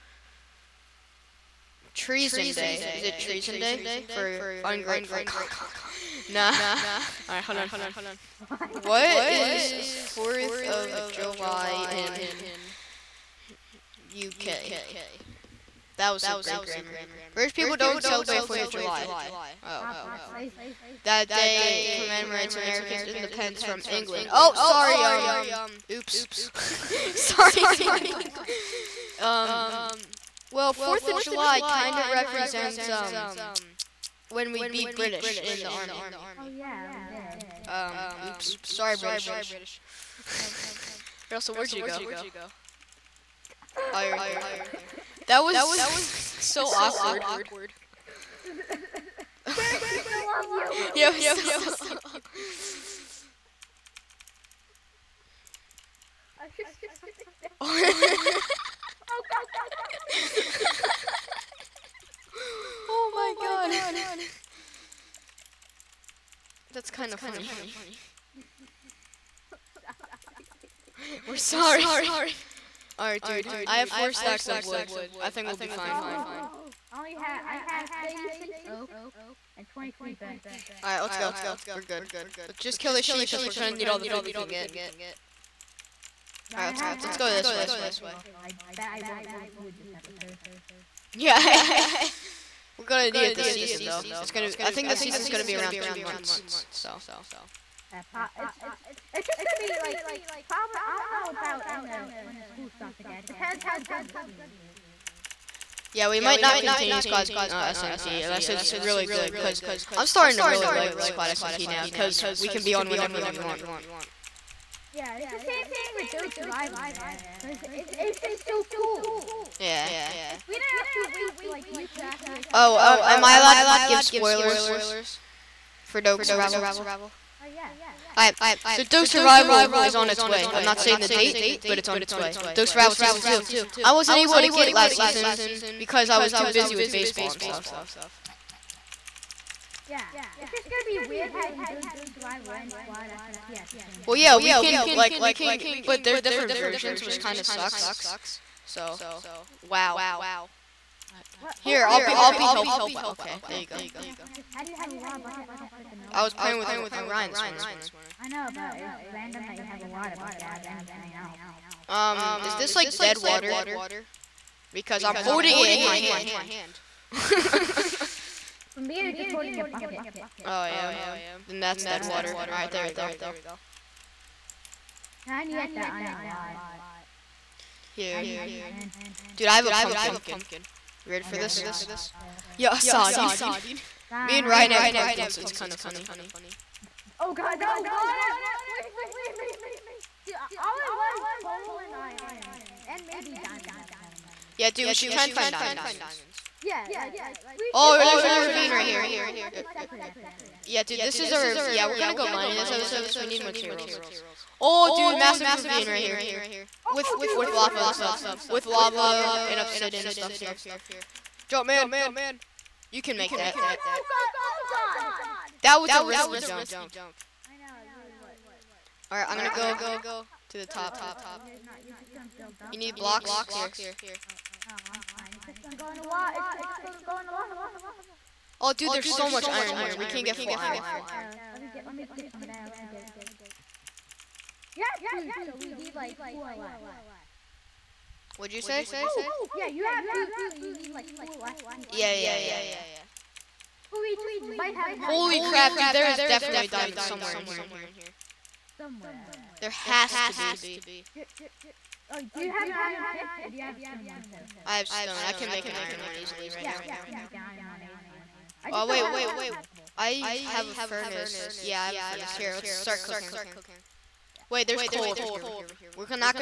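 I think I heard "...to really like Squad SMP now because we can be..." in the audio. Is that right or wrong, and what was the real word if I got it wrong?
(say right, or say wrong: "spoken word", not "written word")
right.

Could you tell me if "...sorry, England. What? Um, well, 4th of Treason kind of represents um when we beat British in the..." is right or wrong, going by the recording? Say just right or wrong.
wrong.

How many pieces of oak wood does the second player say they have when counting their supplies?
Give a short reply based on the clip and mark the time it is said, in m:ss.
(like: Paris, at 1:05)
36, at 1:18.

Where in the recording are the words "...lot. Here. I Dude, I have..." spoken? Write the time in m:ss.
2:56.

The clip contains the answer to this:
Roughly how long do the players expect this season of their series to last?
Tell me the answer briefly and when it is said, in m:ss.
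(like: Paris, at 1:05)
Two months, at 1:35.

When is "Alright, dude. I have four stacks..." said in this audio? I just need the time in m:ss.
1:12.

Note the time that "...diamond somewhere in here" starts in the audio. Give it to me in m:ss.
4:06.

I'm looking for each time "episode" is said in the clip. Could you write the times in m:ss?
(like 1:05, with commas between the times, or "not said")
1:29, 3:22.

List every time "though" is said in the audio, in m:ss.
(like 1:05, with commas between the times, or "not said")
1:33.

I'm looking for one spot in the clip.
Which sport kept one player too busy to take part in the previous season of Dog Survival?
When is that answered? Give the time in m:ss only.
2:16.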